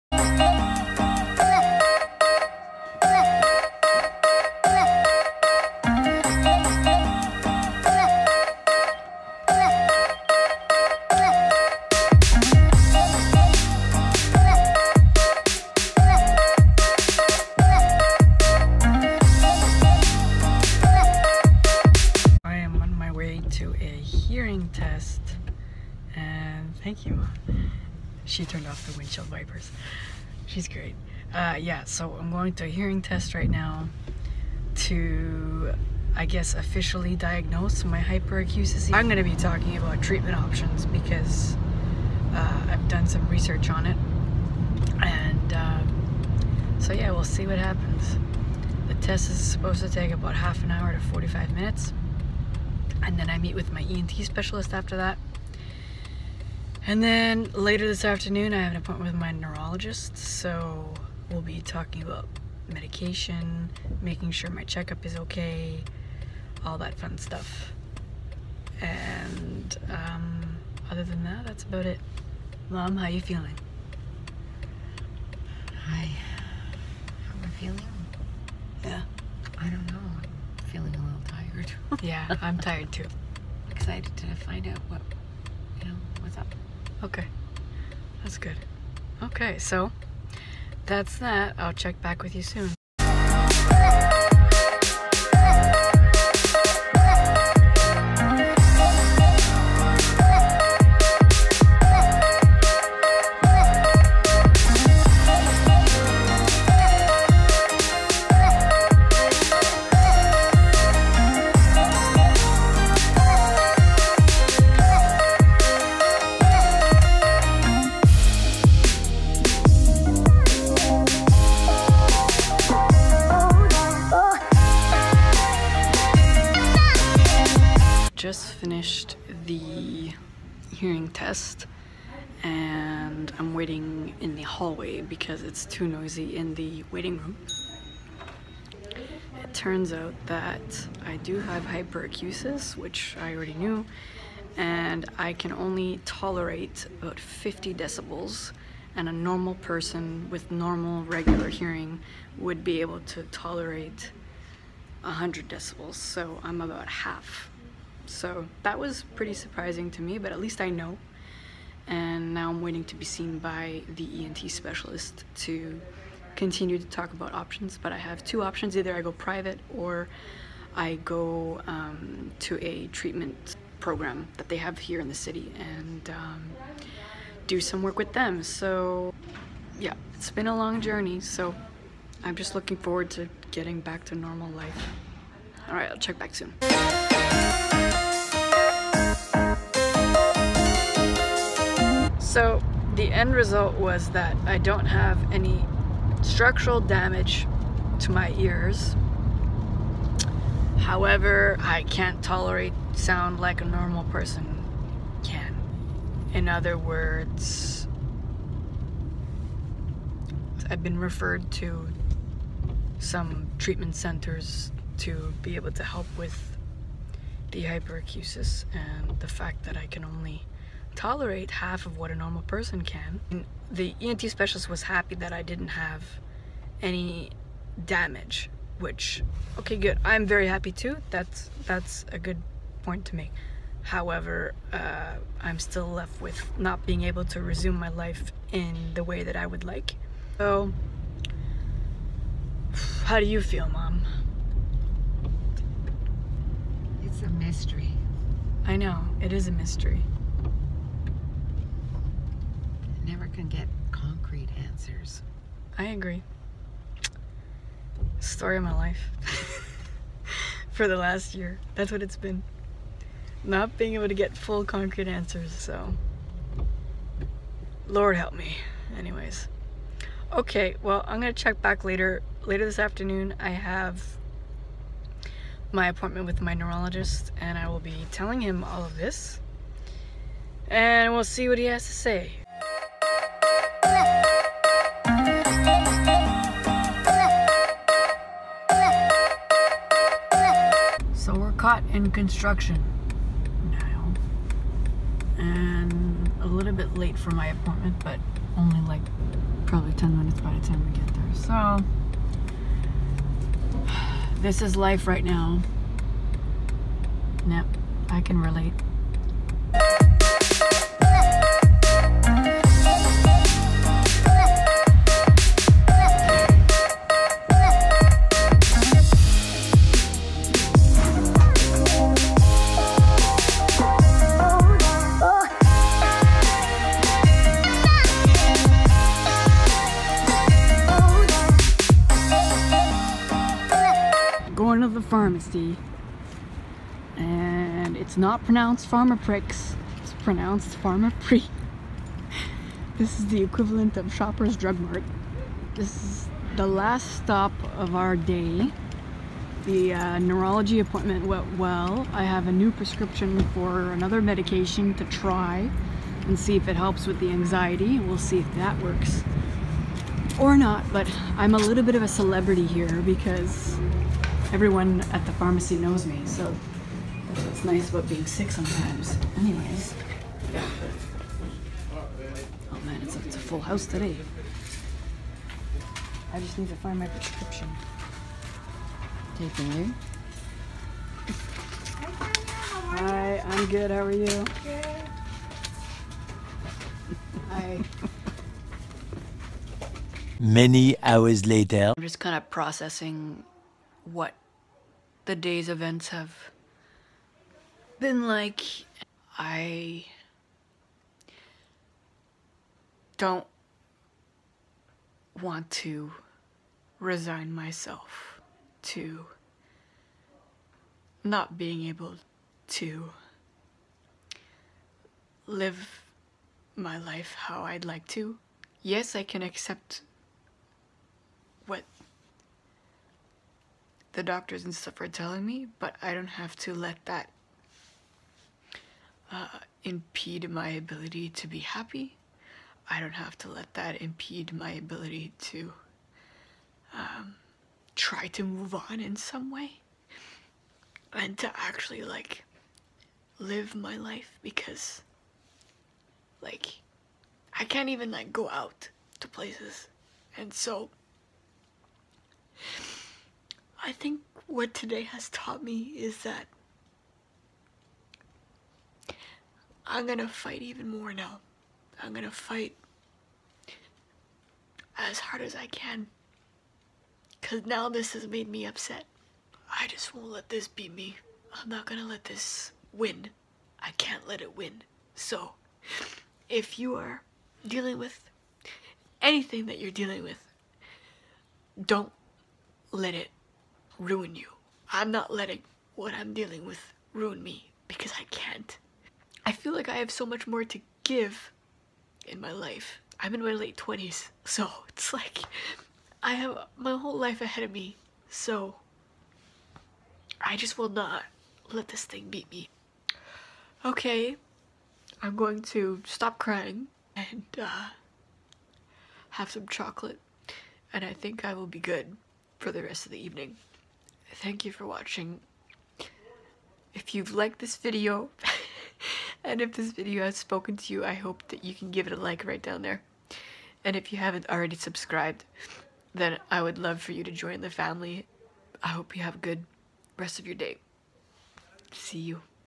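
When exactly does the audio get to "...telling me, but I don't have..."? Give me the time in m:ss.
7:05.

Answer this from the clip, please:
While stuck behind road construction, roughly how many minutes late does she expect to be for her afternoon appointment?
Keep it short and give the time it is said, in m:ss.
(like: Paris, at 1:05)
10, at 4:59.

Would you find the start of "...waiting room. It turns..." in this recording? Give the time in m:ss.
2:16.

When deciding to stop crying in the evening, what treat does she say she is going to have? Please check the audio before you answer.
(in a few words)
Chocolate.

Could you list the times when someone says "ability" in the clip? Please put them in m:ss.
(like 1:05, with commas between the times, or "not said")
7:10, 7:14.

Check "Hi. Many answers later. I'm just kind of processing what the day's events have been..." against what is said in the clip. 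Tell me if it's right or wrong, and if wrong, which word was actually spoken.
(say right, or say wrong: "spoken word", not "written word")
wrong: "hours", not "answers".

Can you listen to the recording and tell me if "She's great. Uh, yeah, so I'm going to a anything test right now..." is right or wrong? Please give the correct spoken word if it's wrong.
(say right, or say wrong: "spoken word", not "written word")
wrong: "hearing", not "anything".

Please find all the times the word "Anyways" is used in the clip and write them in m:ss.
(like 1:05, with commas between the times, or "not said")
4:28, 6:09.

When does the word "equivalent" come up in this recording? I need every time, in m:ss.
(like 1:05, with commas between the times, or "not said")
5:43.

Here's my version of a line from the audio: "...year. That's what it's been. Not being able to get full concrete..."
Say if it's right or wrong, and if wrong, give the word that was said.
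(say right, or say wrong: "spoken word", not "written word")
right.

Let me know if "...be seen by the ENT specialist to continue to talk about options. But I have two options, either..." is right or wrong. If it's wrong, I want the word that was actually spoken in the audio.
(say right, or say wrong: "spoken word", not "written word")
right.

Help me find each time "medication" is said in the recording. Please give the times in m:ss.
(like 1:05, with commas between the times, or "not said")
1:02, 5:54.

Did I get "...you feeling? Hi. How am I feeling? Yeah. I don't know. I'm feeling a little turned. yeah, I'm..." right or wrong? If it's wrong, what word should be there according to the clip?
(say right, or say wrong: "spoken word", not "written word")
wrong: "tired", not "turned".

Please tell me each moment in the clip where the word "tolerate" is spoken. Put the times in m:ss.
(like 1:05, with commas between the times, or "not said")
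2:26, 2:33, 3:22, 3:40.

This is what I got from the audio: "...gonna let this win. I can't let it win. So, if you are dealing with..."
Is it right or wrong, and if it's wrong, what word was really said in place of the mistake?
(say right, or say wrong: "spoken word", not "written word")
right.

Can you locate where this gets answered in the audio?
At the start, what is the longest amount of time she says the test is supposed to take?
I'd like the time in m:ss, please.
0:50.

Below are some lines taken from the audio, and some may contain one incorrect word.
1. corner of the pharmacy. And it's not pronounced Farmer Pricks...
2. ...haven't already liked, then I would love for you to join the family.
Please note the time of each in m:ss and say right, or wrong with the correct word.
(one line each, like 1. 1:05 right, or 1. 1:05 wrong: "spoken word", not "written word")
1. 5:34 right
2. 8:44 wrong: "subscribed", not "liked".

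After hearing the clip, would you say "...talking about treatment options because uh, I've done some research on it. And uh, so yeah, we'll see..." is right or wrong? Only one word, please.
right.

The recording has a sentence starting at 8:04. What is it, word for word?
I'm not letting what I'm dealing with ruin me because I can't.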